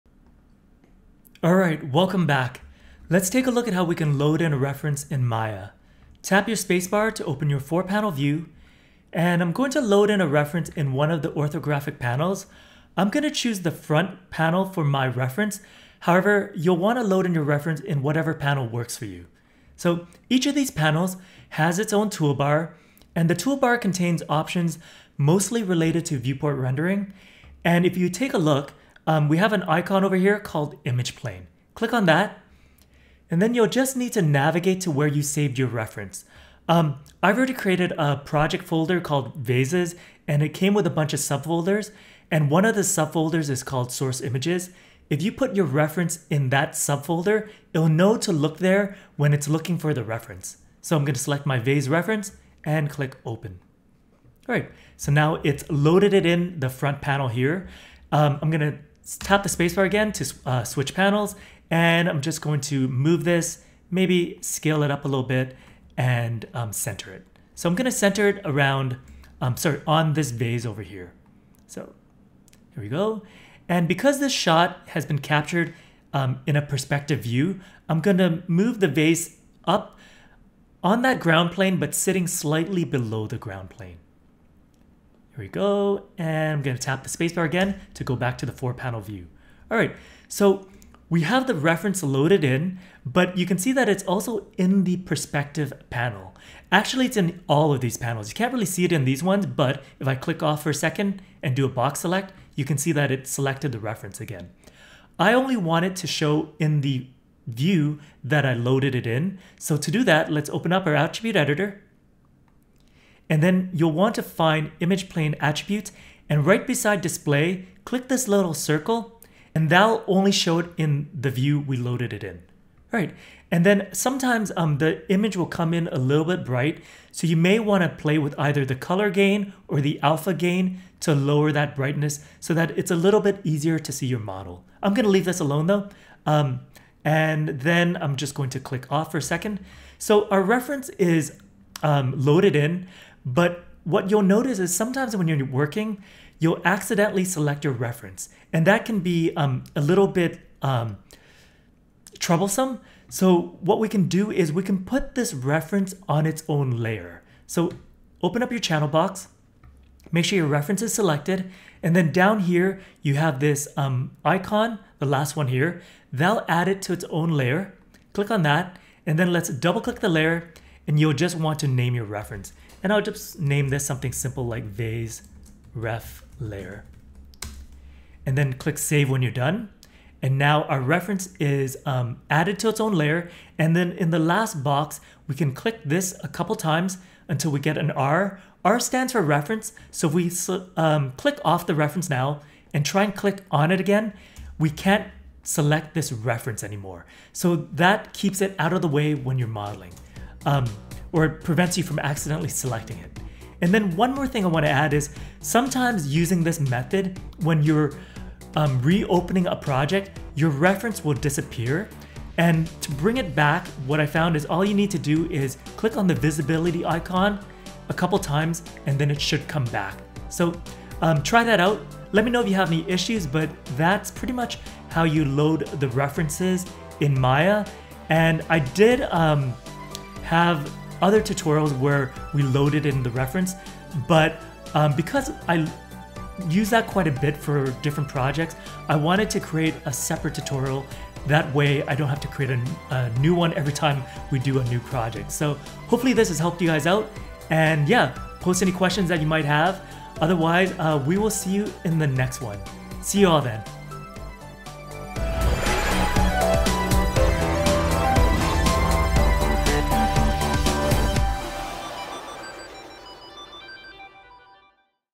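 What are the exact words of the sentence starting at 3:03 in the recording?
And then in the last box, we can click this a couple times until we get an R.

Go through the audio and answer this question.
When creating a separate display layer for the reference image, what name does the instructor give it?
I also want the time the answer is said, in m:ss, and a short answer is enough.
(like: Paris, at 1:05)
vase ref layer, at 2:54.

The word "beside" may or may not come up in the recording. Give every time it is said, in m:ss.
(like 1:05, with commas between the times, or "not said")
1:56.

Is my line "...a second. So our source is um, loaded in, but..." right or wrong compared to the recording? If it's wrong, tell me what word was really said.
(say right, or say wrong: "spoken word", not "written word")
wrong: "reference", not "source".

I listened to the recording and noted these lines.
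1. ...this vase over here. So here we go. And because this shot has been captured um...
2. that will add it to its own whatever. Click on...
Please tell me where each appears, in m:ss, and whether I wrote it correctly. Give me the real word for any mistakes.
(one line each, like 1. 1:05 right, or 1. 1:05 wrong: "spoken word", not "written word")
1. 1:10 right
2. 2:46 wrong: "layer", not "whatever".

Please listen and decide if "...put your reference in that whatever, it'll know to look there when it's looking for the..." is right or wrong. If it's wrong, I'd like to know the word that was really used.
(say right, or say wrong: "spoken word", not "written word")
wrong: "subfolder", not "whatever".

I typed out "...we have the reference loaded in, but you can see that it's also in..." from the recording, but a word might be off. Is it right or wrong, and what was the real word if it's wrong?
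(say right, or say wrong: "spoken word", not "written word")
right.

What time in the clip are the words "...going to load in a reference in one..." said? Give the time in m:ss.
0:09.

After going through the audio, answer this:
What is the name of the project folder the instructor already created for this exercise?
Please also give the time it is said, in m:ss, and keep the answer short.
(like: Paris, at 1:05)
Vases, at 0:39.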